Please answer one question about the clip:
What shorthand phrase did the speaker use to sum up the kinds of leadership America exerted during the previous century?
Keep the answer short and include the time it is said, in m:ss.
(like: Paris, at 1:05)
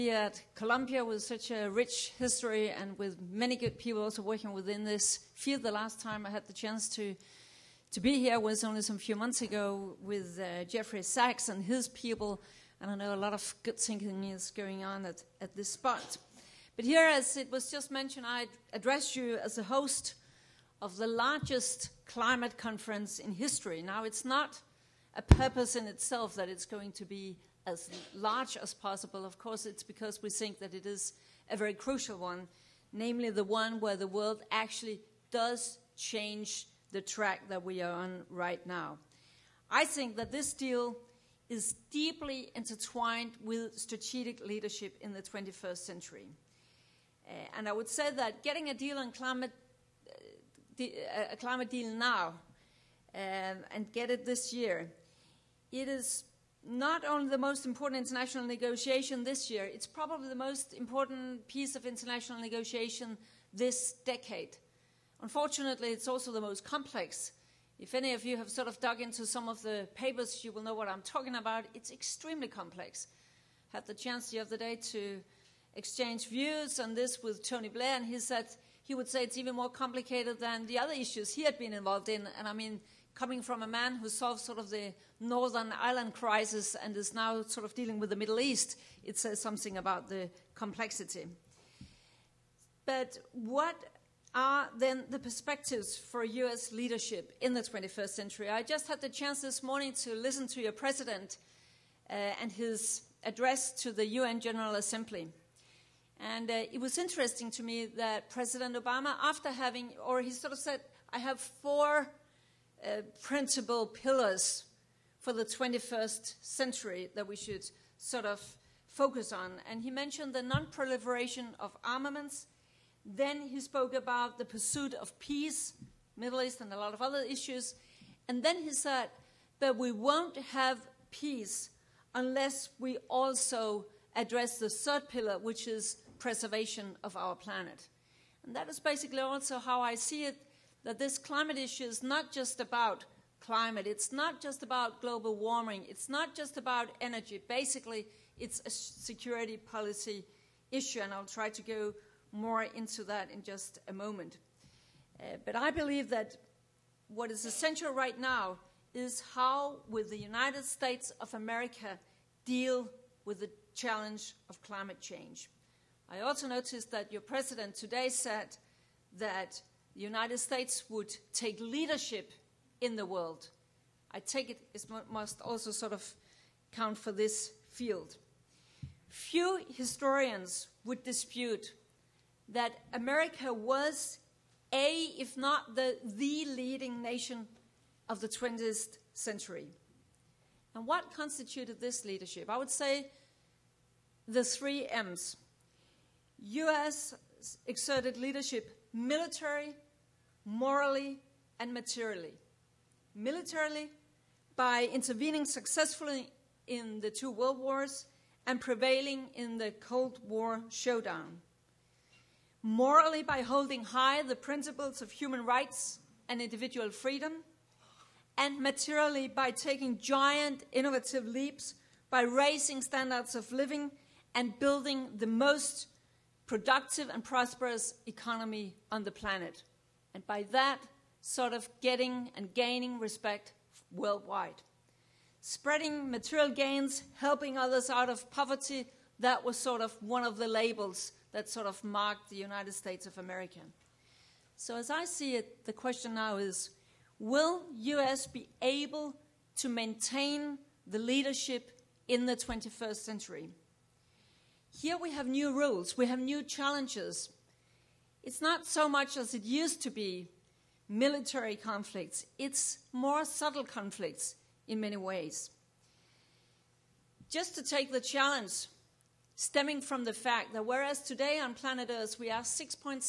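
the three M's, at 3:14.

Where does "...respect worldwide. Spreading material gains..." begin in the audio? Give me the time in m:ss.
3:52.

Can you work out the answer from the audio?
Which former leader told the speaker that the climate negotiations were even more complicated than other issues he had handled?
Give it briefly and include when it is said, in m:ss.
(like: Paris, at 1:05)
Tony Blair, at 1:17.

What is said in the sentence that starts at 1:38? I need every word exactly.
I just had the chance this morning to listen to your president uh, and his address to the UN General Assembly.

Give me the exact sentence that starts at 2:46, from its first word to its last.
I also noticed that your president today said that the United States would take leadership in the world.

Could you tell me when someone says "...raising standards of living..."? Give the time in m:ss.
3:42.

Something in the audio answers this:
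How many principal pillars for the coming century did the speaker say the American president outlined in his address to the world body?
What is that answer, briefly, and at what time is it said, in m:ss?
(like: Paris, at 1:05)
4, at 1:51.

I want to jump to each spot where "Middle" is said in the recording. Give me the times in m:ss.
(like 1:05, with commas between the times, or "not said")
1:28, 2:06.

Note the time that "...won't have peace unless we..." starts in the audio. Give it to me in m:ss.
2:09.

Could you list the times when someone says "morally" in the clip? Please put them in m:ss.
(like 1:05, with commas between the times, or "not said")
3:20, 3:32.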